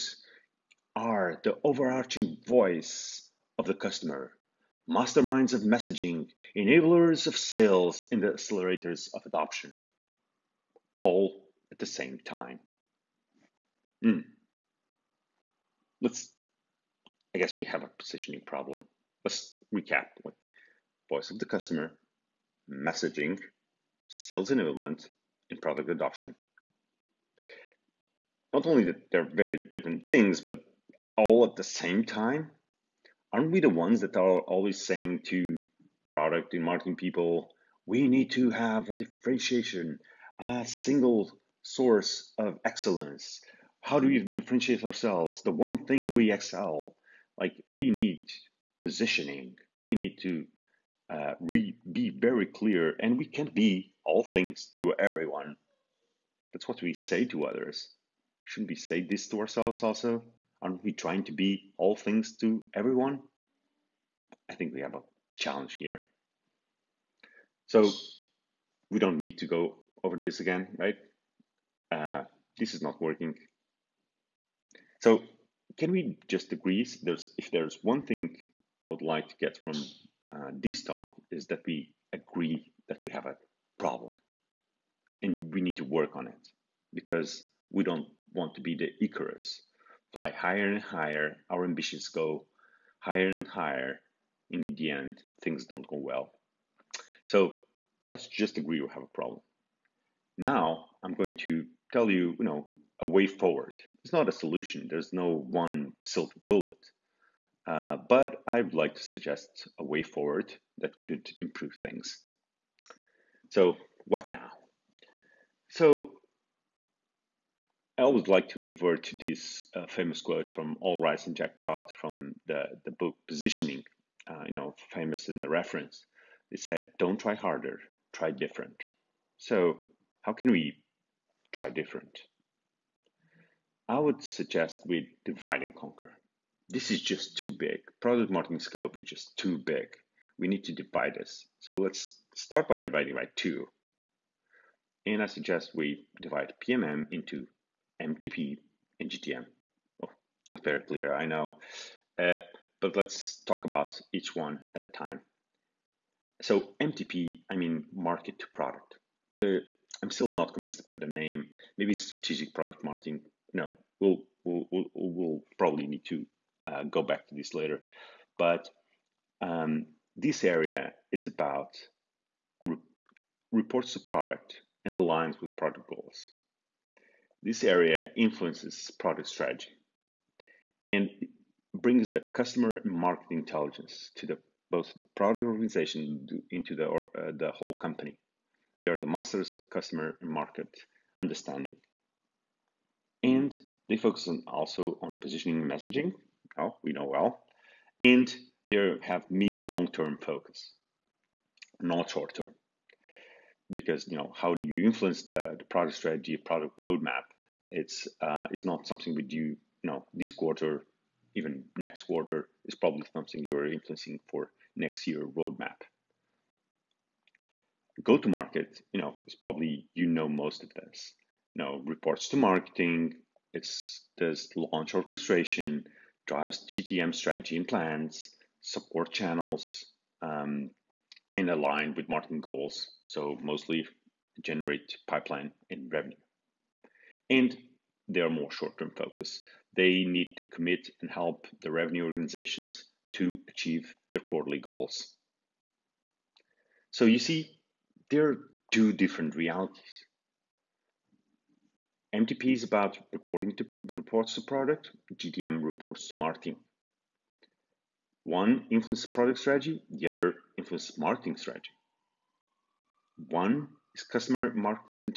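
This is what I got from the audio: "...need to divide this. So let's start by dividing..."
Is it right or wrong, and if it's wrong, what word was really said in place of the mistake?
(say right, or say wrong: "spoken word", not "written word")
right.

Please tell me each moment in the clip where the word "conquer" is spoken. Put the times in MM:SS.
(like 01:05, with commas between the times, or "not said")
02:15.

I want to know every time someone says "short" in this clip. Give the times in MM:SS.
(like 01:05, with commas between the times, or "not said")
03:22, 03:58.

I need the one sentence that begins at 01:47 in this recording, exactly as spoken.
Uh, but I'd like to suggest a way forward that could improve things.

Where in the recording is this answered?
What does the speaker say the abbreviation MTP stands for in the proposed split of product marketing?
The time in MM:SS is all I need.
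02:37.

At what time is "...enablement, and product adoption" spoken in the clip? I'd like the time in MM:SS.
00:24.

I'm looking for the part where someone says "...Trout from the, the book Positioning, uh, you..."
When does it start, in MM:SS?
02:01.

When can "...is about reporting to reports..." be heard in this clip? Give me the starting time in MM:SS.
04:12.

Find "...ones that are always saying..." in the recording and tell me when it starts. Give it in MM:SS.
00:33.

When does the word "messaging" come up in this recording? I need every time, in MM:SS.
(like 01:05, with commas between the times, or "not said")
00:05, 00:22, 03:15.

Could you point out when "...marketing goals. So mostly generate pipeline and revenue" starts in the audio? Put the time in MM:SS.
03:52.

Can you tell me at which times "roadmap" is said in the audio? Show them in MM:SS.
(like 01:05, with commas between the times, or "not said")
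03:26, 03:35.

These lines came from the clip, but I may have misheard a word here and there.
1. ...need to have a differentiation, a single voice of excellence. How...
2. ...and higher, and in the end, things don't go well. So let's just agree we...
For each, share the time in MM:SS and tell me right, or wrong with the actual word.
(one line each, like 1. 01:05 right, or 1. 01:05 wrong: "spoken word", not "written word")
1. 00:38 wrong: "source", not "voice"
2. 01:33 right.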